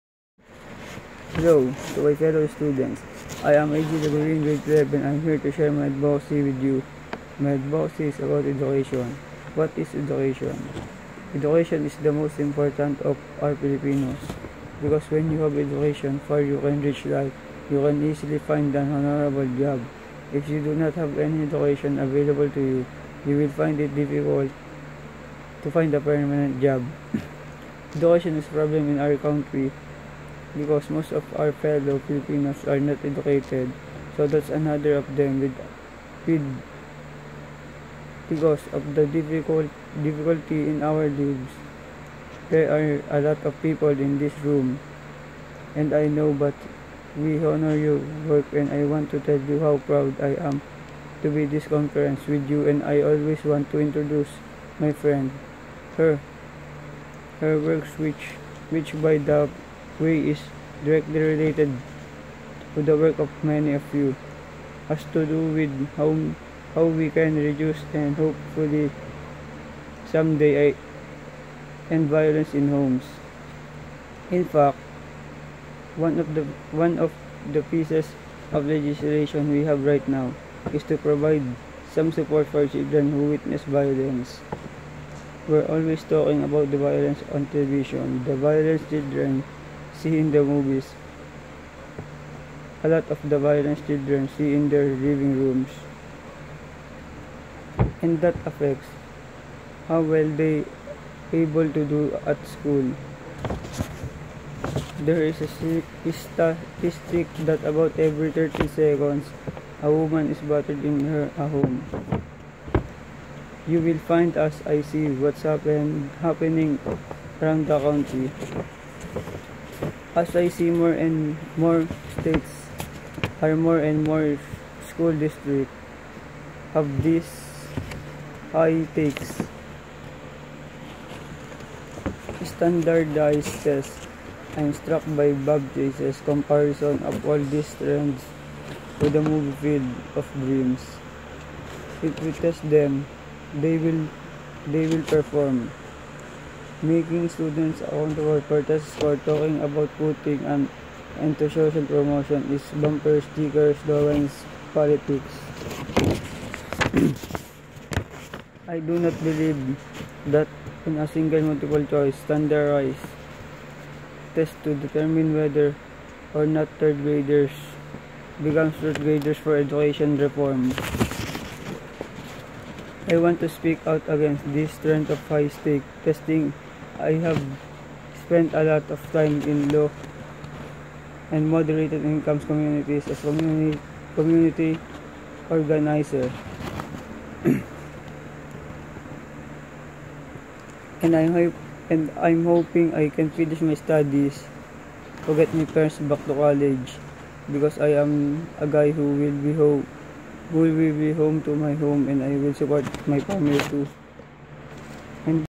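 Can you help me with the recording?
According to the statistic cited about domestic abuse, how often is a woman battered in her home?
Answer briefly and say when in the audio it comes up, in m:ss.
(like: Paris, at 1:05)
Every 30 seconds, at 1:48.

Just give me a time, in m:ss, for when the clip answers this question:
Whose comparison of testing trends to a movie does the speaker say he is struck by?
2:15.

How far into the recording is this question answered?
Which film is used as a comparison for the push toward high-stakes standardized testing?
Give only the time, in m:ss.
2:19.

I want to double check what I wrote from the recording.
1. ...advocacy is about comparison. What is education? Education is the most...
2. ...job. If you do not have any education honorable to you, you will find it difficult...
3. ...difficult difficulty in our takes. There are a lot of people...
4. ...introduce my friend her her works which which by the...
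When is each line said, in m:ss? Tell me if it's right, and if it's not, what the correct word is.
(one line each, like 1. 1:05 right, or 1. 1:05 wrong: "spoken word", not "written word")
1. 0:07 wrong: "education", not "comparison"
2. 0:19 wrong: "available", not "honorable"
3. 0:39 wrong: "lives", not "takes"
4. 0:53 right.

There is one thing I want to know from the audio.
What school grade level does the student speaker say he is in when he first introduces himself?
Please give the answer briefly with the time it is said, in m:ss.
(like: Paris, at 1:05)
Grade 12, at 0:04.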